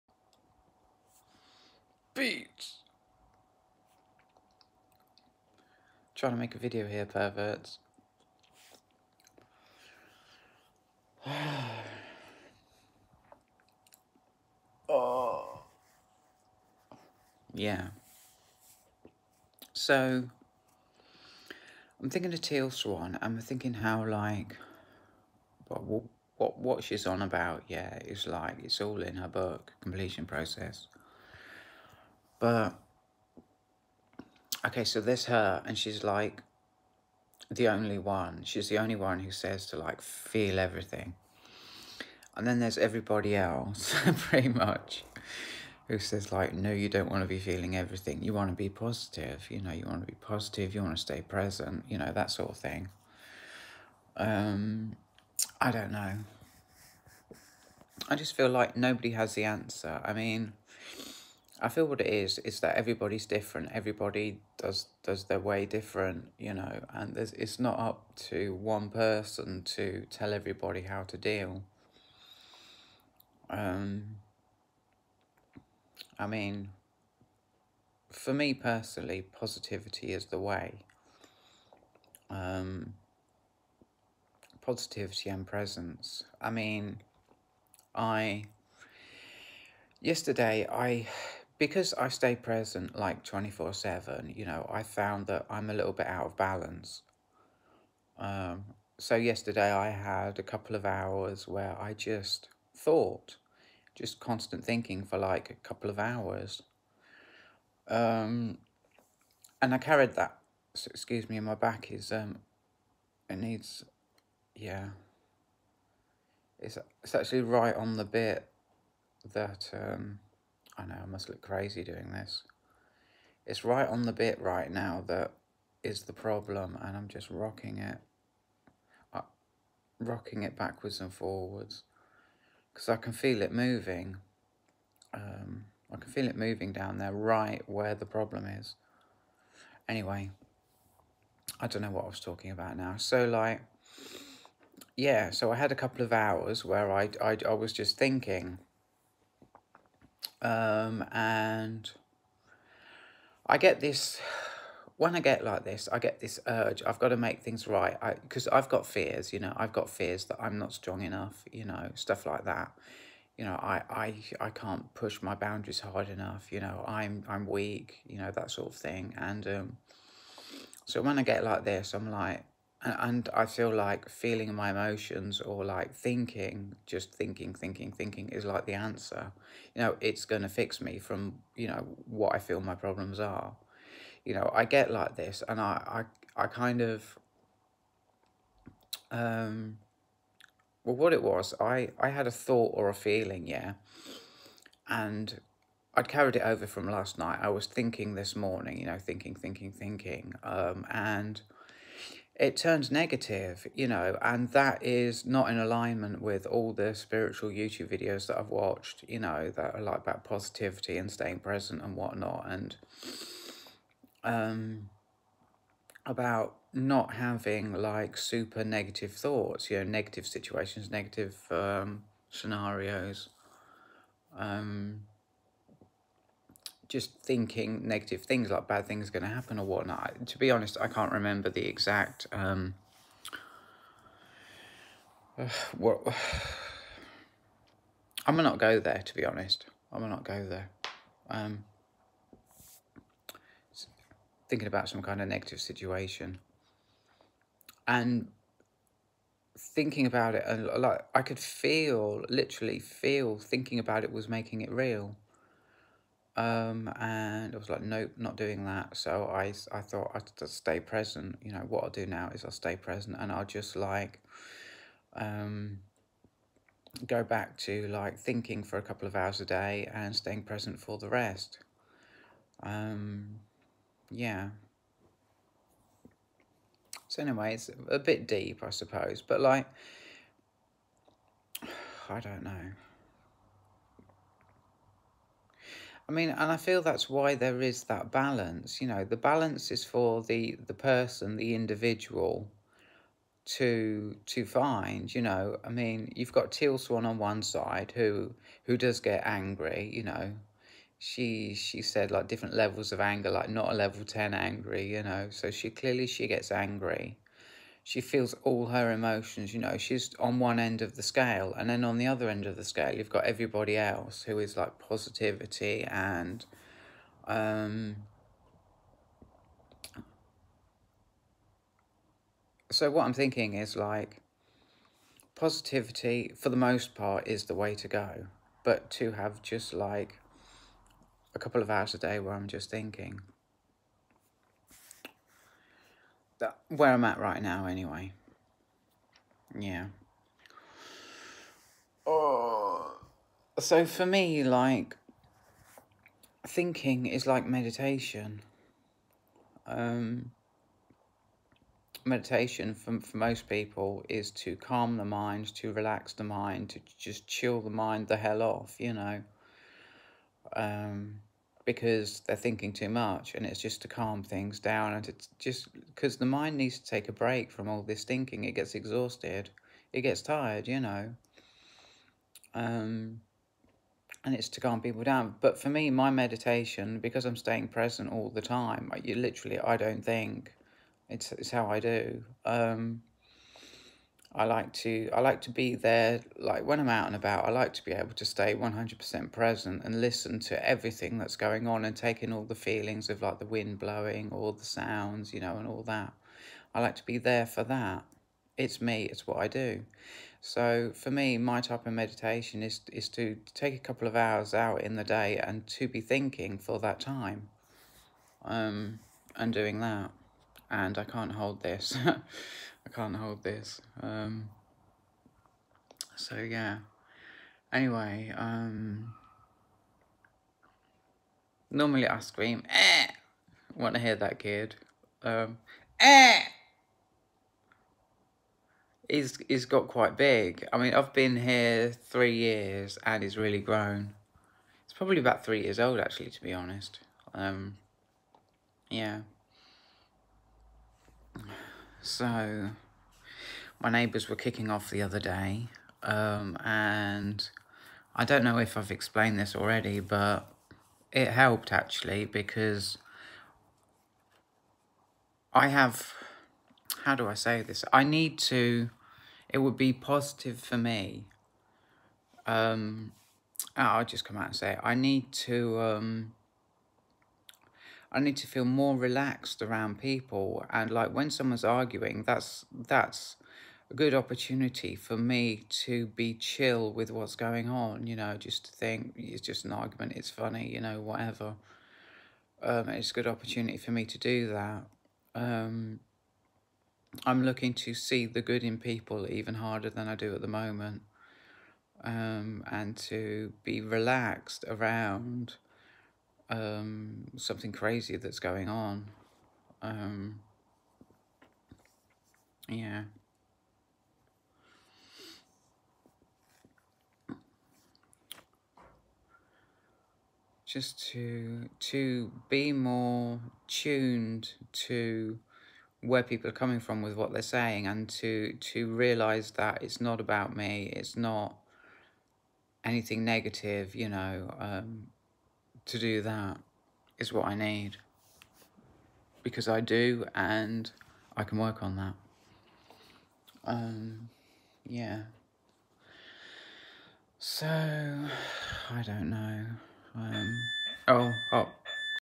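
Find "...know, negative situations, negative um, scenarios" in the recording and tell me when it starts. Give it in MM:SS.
03:39.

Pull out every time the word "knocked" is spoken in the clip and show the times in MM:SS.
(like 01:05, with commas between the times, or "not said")
not said.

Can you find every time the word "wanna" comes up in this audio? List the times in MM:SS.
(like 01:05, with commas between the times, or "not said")
not said.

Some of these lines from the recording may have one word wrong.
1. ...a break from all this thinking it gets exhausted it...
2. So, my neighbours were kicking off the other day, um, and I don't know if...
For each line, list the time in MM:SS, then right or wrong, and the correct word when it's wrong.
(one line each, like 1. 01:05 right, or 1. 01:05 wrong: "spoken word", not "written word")
1. 06:07 right
2. 07:22 right.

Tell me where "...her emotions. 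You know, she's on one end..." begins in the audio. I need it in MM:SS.
05:08.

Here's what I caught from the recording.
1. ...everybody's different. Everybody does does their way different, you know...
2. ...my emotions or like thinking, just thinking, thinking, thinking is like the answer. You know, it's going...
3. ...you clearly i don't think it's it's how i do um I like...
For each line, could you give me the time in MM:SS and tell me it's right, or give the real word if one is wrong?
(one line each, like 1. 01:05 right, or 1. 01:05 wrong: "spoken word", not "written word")
1. 01:02 right
2. 02:54 right
3. 06:19 wrong: "literally", not "clearly".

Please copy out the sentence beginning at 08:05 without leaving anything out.
Um, I'm looking to see the good in people even harder than I do at the moment.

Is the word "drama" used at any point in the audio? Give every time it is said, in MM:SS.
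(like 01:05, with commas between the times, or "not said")
not said.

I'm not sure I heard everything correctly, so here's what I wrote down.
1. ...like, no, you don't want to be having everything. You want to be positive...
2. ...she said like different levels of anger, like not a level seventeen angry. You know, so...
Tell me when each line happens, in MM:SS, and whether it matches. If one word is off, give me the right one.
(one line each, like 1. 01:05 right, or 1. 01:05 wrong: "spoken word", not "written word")
1. 00:46 wrong: "feeling", not "having"
2. 05:01 wrong: "ten", not "seventeen".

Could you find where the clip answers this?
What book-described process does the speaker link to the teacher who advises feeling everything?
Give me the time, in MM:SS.
00:29.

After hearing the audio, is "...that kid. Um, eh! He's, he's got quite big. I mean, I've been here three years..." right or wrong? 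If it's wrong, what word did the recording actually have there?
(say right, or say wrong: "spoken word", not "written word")
right.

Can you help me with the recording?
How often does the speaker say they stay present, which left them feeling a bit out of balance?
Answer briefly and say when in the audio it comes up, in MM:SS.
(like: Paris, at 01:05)
24/7, at 01:33.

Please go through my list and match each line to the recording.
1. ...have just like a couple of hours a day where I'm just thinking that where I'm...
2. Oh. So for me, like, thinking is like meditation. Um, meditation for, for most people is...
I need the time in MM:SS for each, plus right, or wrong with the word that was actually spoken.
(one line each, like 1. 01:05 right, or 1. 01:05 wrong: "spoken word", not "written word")
1. 05:29 right
2. 05:42 right.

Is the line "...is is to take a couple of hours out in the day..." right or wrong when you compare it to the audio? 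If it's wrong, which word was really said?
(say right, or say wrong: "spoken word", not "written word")
right.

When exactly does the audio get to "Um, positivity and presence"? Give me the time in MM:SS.
01:22.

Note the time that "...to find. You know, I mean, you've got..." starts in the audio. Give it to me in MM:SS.
04:54.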